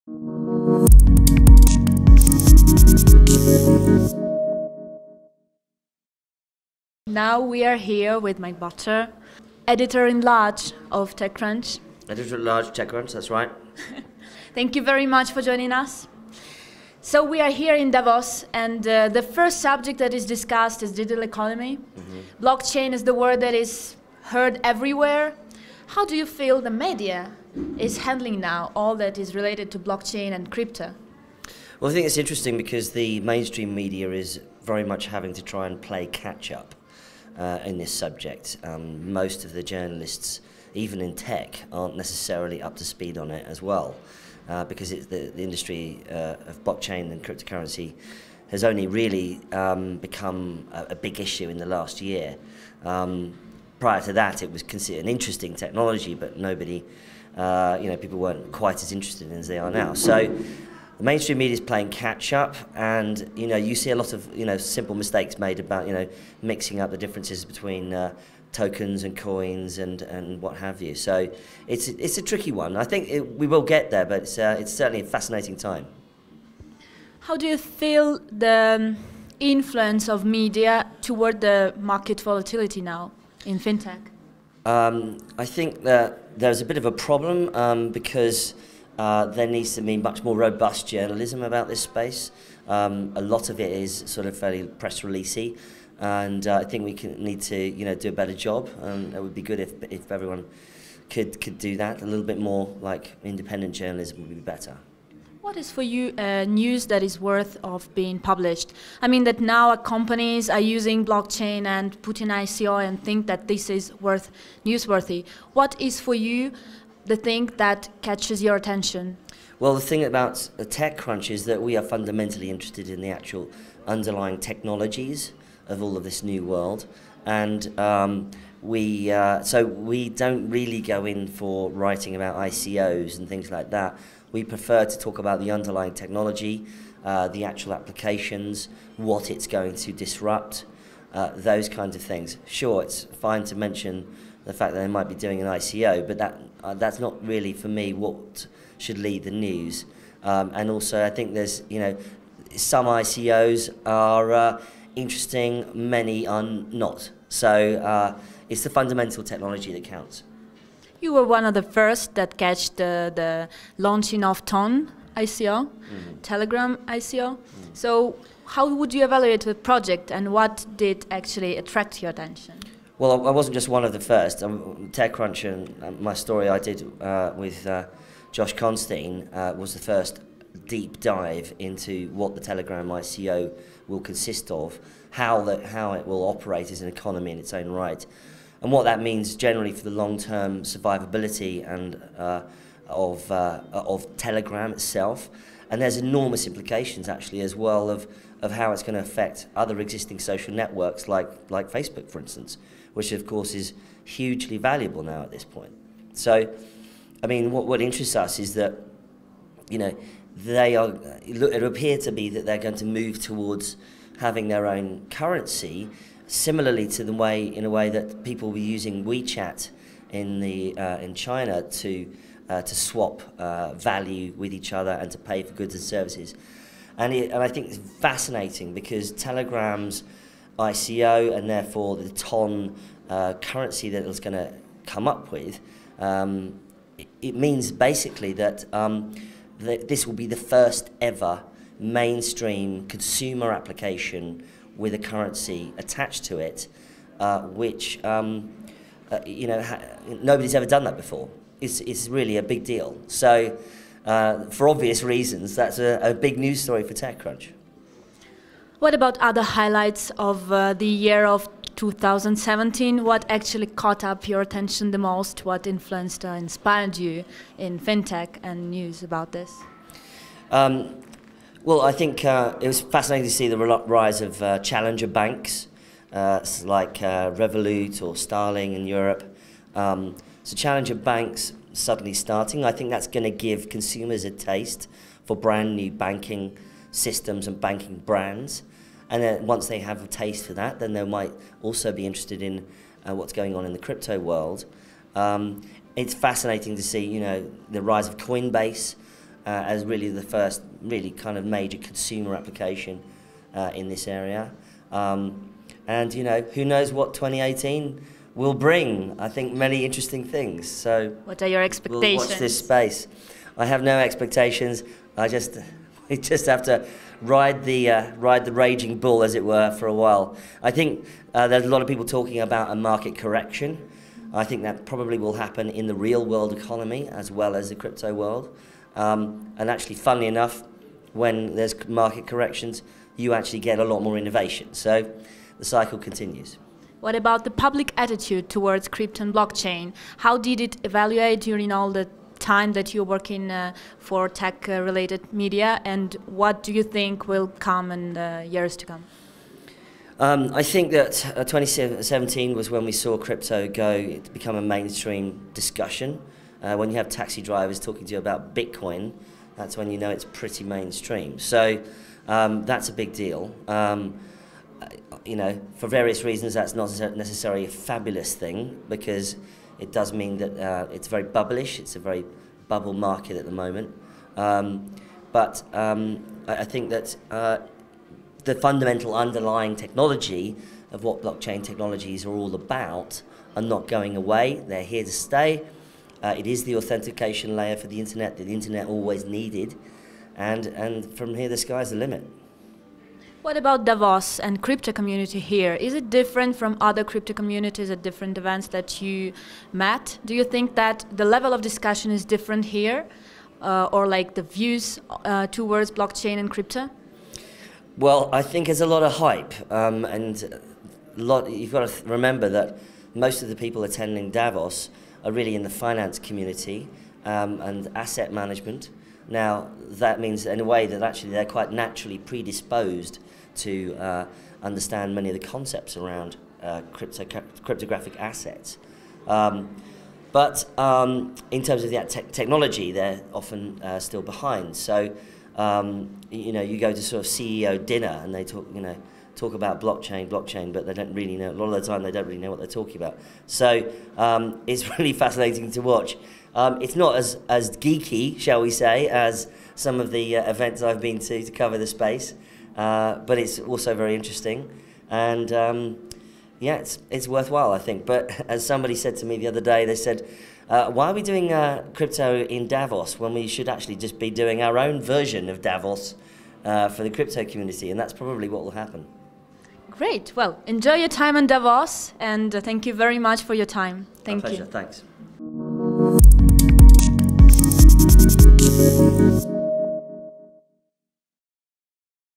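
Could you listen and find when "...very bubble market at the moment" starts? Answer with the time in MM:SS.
06:11.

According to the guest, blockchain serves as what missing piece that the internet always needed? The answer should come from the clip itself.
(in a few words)
The authentication layer.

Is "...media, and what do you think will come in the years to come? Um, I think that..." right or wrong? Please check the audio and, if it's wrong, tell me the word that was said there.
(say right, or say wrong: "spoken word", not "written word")
right.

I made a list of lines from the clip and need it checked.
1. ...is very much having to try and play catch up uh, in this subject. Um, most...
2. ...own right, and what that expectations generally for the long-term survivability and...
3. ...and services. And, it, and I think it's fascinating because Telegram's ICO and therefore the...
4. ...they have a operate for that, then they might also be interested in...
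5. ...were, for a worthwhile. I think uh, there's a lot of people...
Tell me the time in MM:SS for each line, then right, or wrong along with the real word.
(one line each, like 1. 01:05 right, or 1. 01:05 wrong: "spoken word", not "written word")
1. 00:34 right
2. 03:07 wrong: "means", not "expectations"
3. 03:45 right
4. 04:49 wrong: "taste", not "operate"
5. 05:19 wrong: "while", not "worthwhile".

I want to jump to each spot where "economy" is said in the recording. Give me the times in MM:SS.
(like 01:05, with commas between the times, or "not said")
00:21, 03:06, 05:26.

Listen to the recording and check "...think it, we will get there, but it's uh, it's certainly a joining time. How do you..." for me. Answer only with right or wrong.
wrong.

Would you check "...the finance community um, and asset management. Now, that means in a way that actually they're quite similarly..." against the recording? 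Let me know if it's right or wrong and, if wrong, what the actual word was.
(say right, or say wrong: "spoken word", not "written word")
wrong: "naturally", not "similarly".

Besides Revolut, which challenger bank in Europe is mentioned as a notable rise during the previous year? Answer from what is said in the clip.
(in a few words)
Starling.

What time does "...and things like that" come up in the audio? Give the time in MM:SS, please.
02:13.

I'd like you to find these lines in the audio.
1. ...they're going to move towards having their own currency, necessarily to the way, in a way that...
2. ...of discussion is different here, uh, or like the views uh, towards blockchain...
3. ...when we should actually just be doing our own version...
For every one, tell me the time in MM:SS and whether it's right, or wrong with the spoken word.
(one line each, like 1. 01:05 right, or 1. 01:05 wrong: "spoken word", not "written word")
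1. 03:32 wrong: "similarly", not "necessarily"
2. 06:41 right
3. 07:43 right.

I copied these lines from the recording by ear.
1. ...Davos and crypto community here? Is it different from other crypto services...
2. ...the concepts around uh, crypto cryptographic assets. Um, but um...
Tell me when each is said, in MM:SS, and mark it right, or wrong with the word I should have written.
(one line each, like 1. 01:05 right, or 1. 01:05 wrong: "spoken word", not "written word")
1. 06:33 wrong: "communities", not "services"
2. 07:05 right.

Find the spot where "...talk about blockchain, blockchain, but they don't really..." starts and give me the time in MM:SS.
07:19.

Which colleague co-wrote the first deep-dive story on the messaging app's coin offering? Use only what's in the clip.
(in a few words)
Josh Constine.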